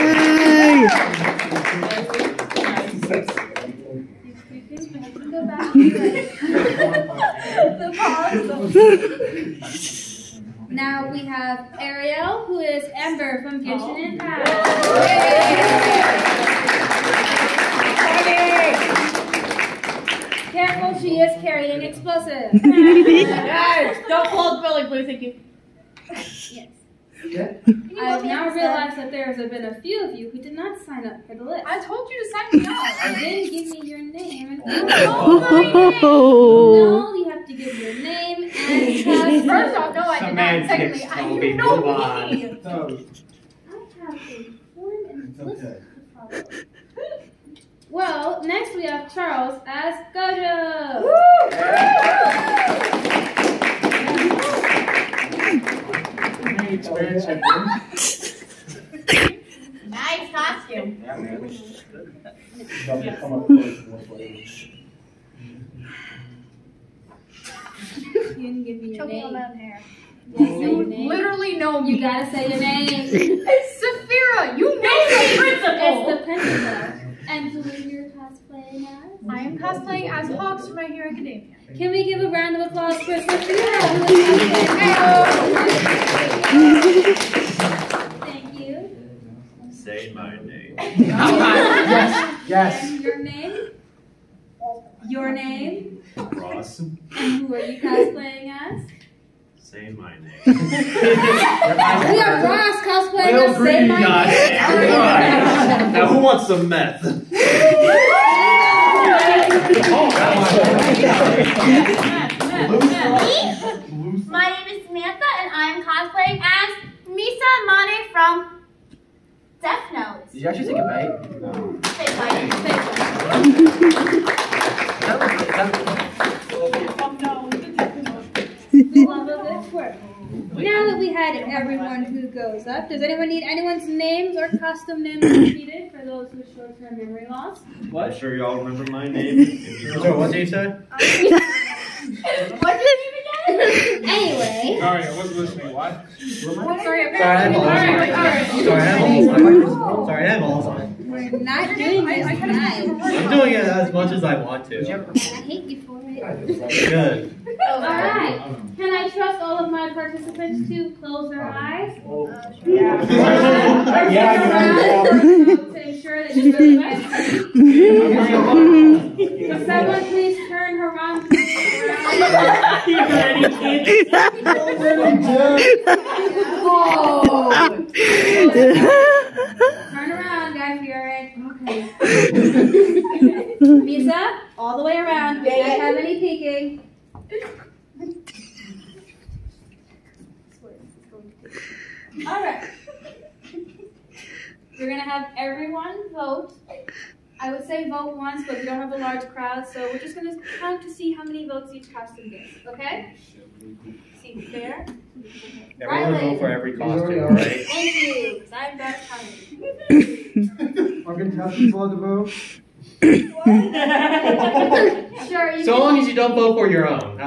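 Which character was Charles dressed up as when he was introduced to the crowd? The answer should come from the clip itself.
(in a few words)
Gojo.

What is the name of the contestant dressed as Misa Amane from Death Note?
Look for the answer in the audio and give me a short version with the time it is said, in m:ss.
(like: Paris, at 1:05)
Samantha, at 1:54.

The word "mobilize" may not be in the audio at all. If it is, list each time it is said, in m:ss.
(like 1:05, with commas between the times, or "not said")
not said.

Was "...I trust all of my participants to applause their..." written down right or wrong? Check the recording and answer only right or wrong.
wrong.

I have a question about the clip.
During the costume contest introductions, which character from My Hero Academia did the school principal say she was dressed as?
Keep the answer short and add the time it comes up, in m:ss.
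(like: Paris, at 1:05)
Hawks, at 1:20.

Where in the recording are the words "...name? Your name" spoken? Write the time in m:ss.
1:33.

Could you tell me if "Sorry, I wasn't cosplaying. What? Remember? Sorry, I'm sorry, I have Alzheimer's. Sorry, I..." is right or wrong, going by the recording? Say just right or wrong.
wrong.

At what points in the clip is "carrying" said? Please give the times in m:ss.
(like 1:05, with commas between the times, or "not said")
0:21.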